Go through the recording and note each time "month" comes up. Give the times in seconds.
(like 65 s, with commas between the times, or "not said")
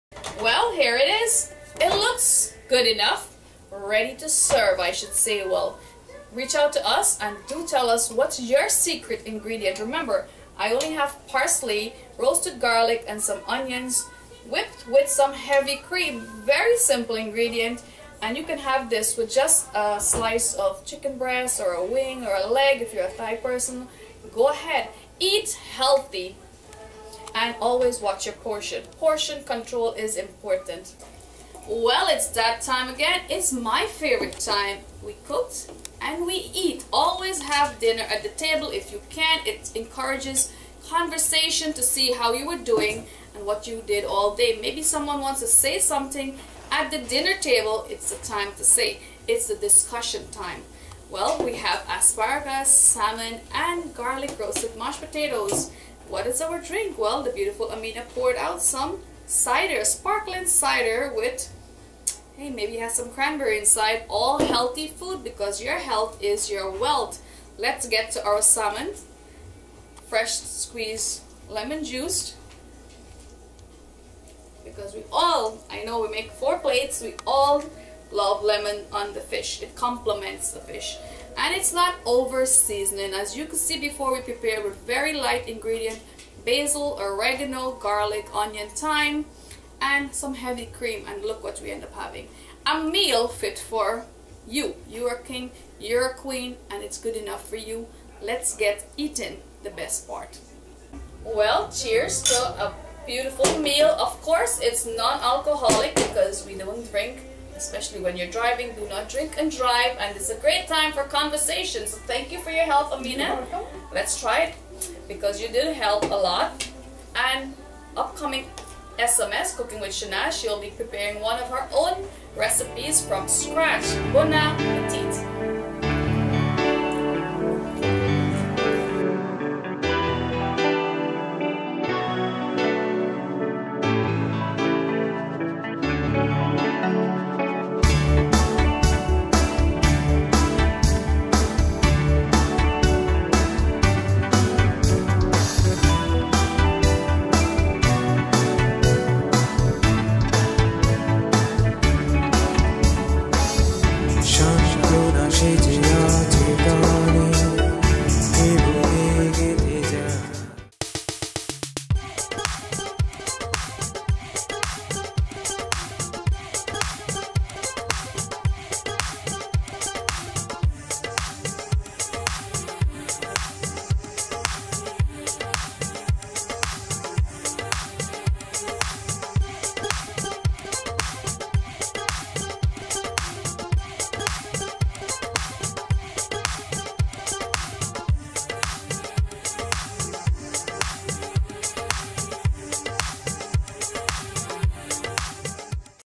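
not said.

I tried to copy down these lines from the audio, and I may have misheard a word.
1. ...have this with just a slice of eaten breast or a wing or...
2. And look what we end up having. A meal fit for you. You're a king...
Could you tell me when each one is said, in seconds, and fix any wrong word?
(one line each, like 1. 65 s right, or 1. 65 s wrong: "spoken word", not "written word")
1. 18 s wrong: "chicken", not "eaten"
2. 91 s right.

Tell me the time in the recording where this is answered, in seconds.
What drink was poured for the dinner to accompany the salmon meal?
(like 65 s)
59 s.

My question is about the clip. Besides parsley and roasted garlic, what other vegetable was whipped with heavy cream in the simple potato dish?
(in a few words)
onions.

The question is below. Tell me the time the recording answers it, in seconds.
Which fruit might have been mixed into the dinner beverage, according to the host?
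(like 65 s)
63 s.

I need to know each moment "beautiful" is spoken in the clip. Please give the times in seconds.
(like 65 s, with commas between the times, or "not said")
57 s, 103 s.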